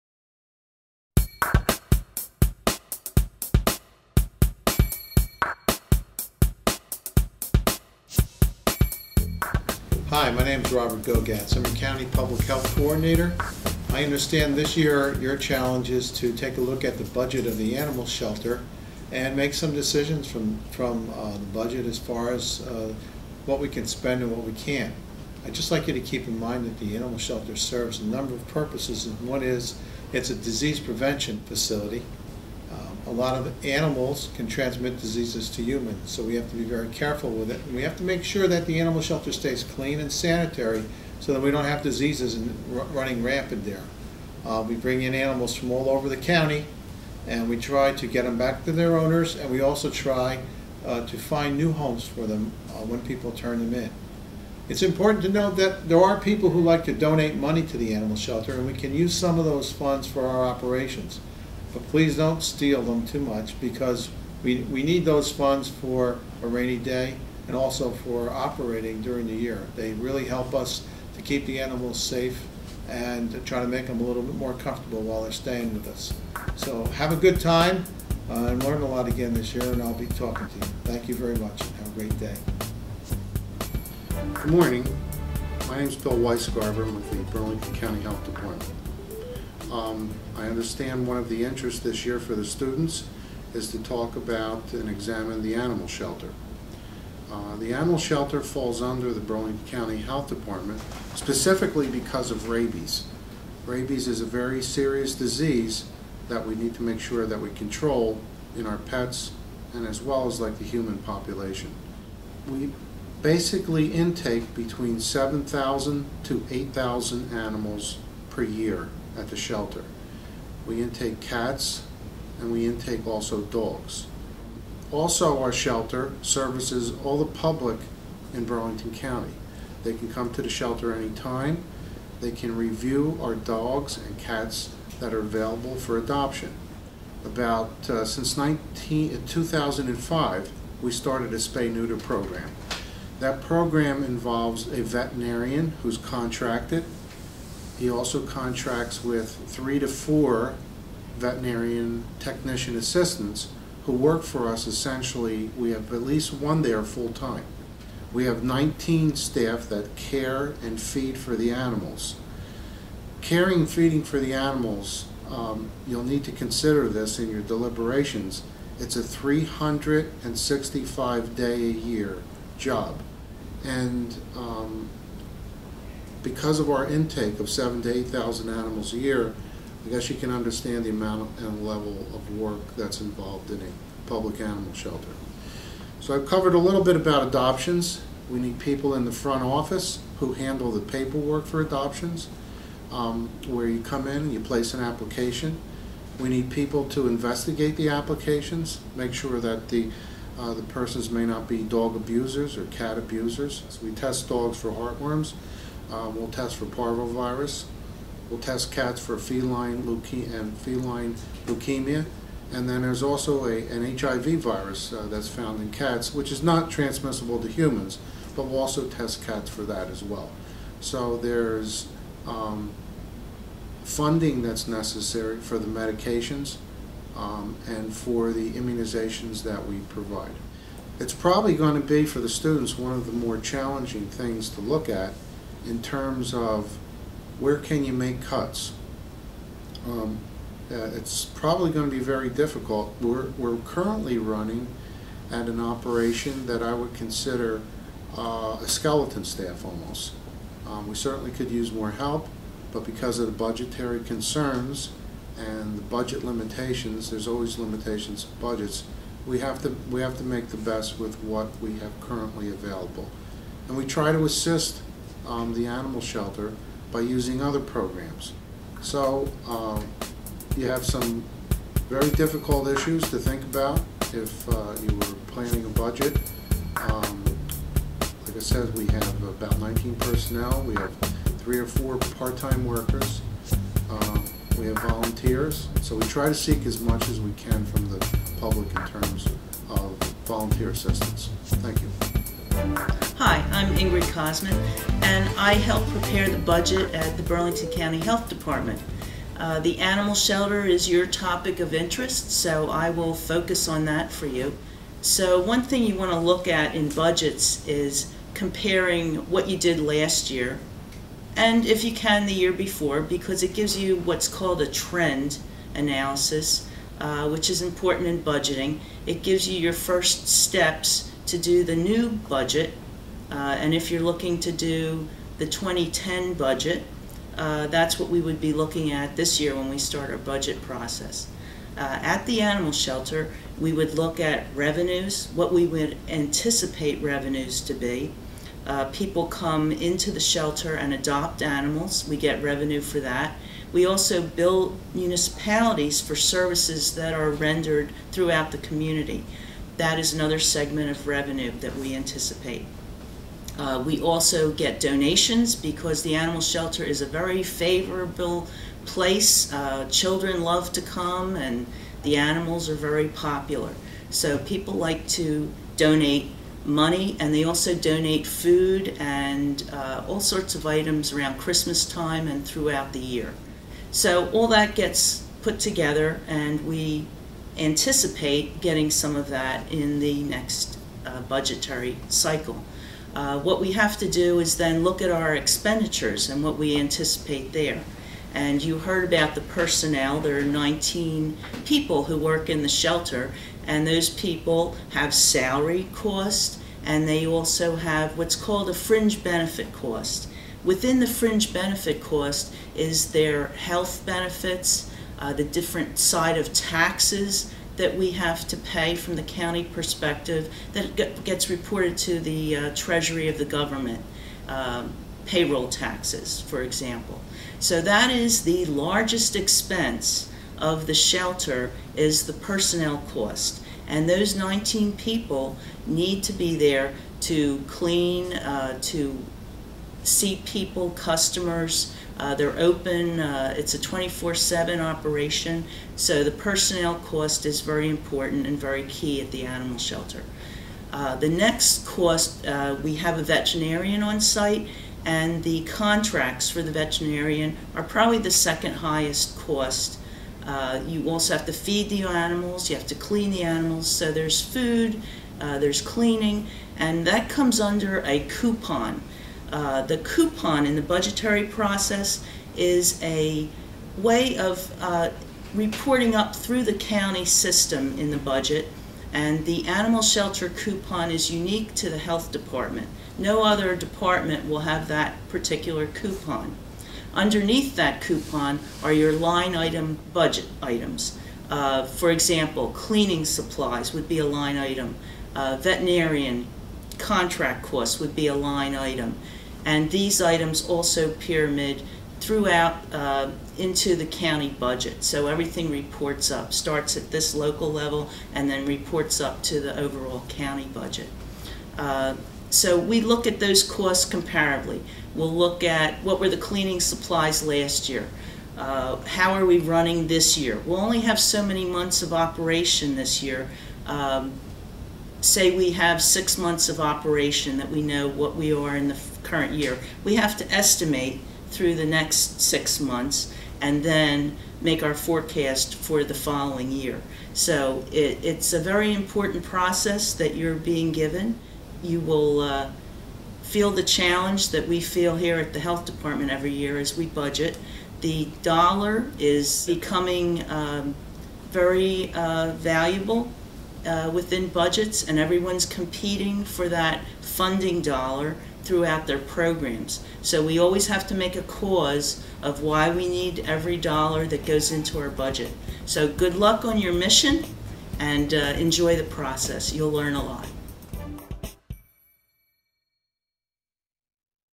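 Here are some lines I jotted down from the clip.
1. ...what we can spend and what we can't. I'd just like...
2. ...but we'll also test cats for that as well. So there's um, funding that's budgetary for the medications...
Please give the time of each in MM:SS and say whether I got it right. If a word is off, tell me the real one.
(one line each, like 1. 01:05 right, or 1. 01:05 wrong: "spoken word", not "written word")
1. 00:23 right
2. 03:38 wrong: "necessary", not "budgetary".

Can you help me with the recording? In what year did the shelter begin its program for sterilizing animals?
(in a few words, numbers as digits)
2005.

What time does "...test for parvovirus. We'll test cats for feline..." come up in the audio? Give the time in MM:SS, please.
03:26.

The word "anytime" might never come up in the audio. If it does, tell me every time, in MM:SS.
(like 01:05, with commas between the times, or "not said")
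02:10.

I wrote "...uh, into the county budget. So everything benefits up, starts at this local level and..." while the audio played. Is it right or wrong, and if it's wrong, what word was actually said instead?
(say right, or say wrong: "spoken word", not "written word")
wrong: "reports", not "benefits".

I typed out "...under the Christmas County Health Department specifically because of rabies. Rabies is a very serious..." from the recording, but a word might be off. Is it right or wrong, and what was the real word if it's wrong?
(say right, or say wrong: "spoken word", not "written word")
wrong: "Burlington", not "Christmas".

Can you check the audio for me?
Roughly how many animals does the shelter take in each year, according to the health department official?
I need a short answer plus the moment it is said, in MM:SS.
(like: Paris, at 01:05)
7,000 to 8,000, at 01:54.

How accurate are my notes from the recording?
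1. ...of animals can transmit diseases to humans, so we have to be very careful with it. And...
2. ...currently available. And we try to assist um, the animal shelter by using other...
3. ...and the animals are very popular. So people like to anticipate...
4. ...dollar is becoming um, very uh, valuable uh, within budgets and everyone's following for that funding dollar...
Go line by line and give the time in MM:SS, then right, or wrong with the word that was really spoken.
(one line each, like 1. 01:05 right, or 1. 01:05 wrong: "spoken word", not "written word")
1. 00:33 right
2. 04:22 right
3. 06:01 wrong: "donate", not "anticipate"
4. 08:58 wrong: "competing", not "following".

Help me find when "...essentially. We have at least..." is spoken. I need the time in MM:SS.
02:34.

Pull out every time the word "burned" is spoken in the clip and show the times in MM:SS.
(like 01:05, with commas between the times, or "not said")
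not said.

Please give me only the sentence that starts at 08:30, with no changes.
We'll only have so many months of operation this year.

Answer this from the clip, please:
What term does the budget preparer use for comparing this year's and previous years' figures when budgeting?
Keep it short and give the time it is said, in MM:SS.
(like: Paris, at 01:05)
Trend analysis, at 05:14.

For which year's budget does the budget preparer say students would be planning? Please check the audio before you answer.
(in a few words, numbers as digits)
2010.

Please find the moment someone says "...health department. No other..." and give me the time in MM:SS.
07:51.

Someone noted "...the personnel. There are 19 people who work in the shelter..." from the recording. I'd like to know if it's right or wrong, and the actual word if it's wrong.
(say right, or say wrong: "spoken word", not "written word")
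right.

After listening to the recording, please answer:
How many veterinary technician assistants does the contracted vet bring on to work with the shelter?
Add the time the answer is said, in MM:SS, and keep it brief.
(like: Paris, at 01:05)
3 to 4, at 02:29.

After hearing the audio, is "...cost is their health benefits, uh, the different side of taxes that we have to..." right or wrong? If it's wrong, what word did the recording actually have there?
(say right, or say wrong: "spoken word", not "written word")
right.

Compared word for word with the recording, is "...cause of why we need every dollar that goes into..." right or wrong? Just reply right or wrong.
right.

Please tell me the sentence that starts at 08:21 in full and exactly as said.
Uh, so we look at those costs comparably.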